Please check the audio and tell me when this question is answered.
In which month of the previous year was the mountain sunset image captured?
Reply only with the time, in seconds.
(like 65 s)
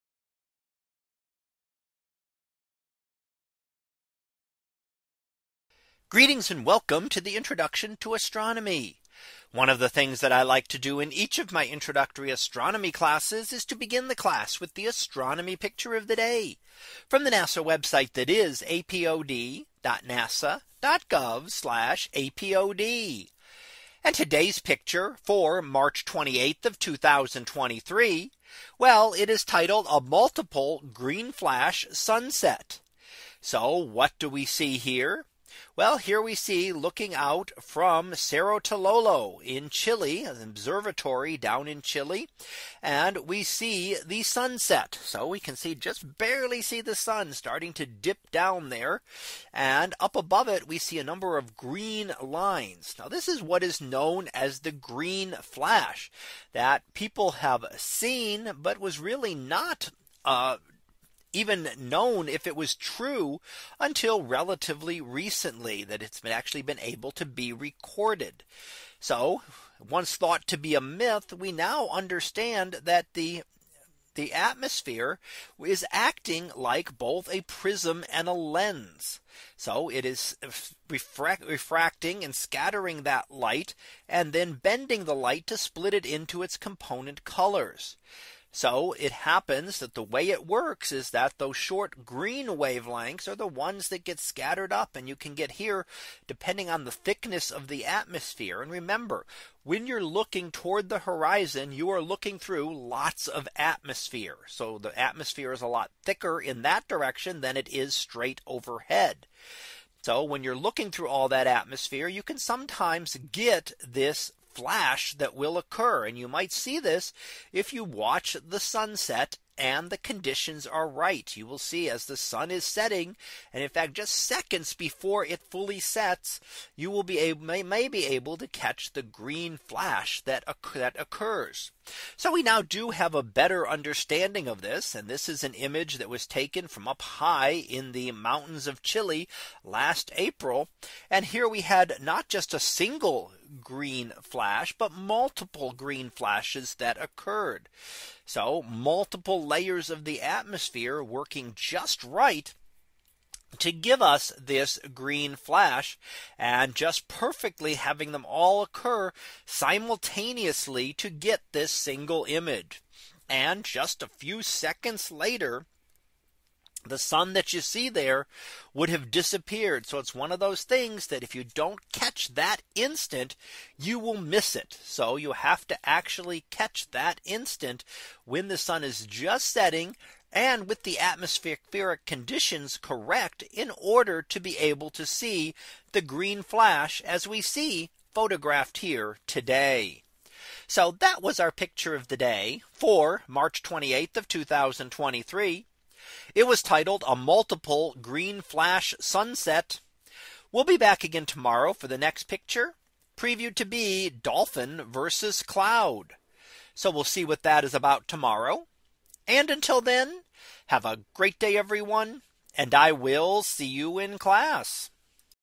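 139 s.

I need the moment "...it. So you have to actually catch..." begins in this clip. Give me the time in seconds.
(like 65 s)
174 s.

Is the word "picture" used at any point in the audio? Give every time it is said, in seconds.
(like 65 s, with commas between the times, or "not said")
15 s, 24 s, 191 s, 202 s.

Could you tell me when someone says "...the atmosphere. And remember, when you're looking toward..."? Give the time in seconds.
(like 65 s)
97 s.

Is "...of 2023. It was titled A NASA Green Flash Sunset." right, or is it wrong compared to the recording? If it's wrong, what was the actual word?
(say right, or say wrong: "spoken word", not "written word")
wrong: "Multiple", not "NASA".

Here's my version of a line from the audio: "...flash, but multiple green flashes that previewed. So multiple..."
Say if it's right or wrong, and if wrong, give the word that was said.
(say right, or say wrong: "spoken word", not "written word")
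wrong: "occurred", not "previewed".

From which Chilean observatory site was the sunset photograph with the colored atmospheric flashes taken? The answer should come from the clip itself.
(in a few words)
Cerro Tololo.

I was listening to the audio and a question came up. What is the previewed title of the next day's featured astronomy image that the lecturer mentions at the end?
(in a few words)
Dolphin versus cloud.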